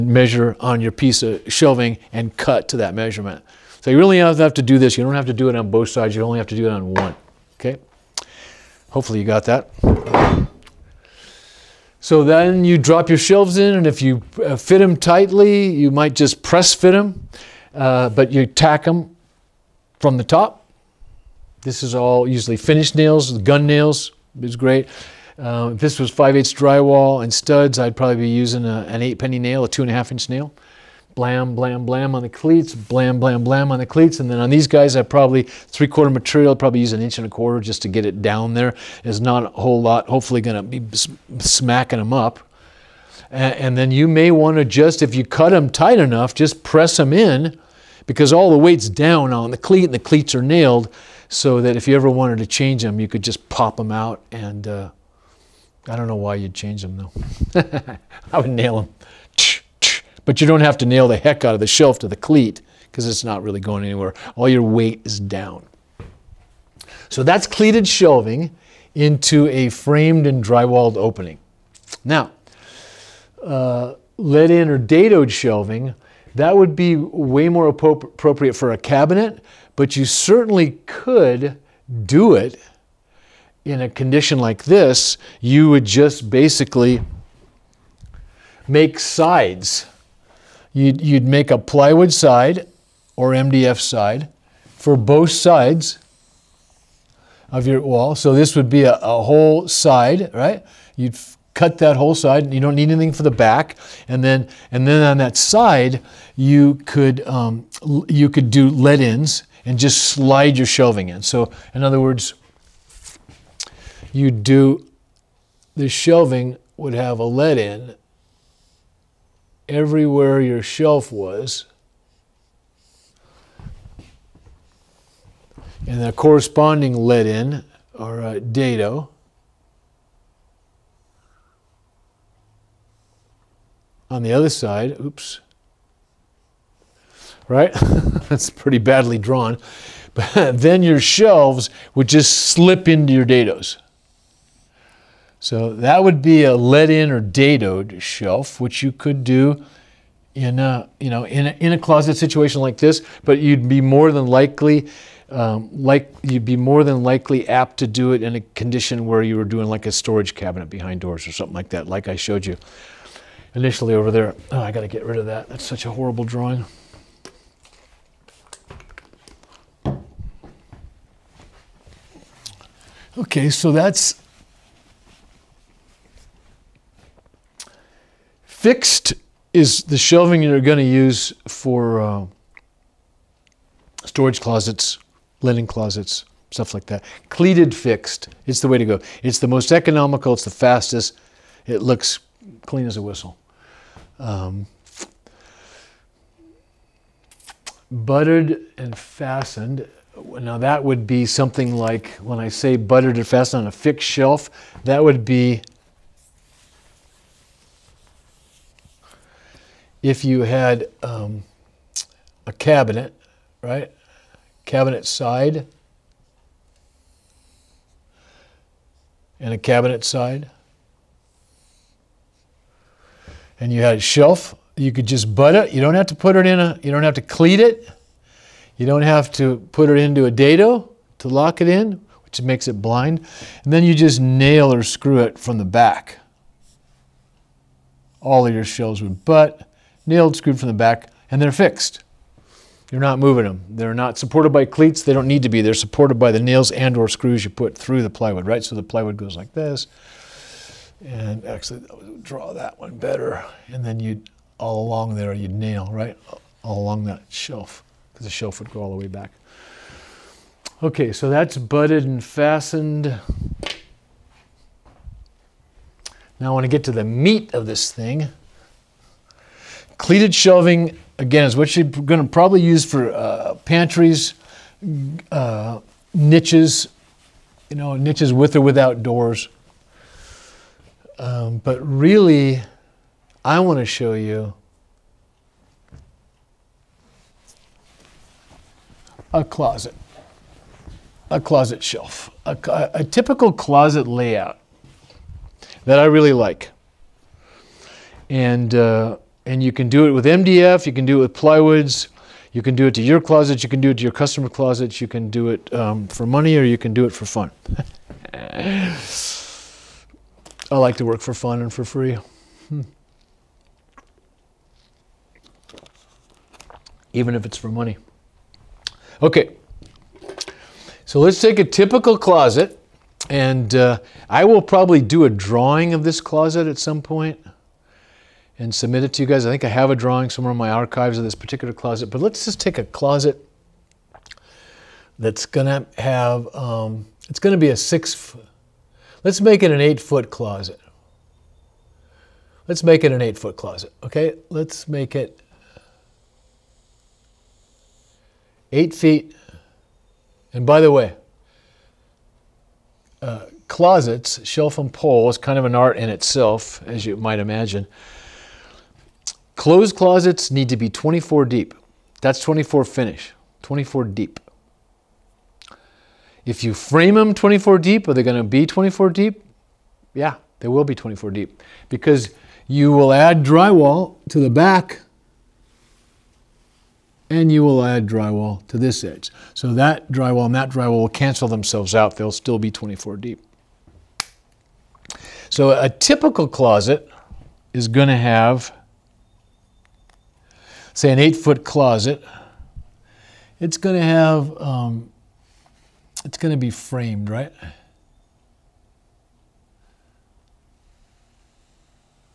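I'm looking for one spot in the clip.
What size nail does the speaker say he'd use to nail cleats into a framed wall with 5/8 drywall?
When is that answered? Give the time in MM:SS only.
00:29.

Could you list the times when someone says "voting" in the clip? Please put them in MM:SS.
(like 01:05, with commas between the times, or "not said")
not said.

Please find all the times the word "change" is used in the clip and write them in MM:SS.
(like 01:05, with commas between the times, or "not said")
00:52, 00:56.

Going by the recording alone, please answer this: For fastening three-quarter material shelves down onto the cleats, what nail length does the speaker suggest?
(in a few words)
an inch and a quarter.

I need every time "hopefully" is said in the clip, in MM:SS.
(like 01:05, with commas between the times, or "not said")
00:08, 00:40.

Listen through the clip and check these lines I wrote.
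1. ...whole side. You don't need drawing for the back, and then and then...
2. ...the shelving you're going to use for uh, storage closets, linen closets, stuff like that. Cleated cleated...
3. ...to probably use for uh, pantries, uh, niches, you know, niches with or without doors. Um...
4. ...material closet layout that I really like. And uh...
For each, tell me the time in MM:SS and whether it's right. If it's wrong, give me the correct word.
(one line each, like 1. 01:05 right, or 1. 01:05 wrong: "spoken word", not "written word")
1. 01:41 wrong: "anything", not "drawing"
2. 02:59 wrong: "fixed", not "cleated"
3. 04:32 right
4. 04:53 wrong: "typical", not "material".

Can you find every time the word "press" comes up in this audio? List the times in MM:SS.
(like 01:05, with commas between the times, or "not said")
00:16, 00:46.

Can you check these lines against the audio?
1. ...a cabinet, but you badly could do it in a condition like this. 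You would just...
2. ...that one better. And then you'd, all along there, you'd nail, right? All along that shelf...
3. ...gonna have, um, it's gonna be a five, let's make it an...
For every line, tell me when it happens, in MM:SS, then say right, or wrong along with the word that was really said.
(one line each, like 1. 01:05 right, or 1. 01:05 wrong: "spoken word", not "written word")
1. 01:18 wrong: "certainly", not "badly"
2. 04:12 right
3. 05:35 wrong: "six", not "five".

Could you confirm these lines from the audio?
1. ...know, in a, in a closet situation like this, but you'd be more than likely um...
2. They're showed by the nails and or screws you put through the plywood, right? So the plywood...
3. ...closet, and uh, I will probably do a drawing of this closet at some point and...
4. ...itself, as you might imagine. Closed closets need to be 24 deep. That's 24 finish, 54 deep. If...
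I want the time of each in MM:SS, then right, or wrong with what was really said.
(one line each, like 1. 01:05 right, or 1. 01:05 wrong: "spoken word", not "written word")
1. 02:31 right
2. 04:05 wrong: "supported", not "showed"
3. 05:22 right
4. 05:56 wrong: "24", not "54".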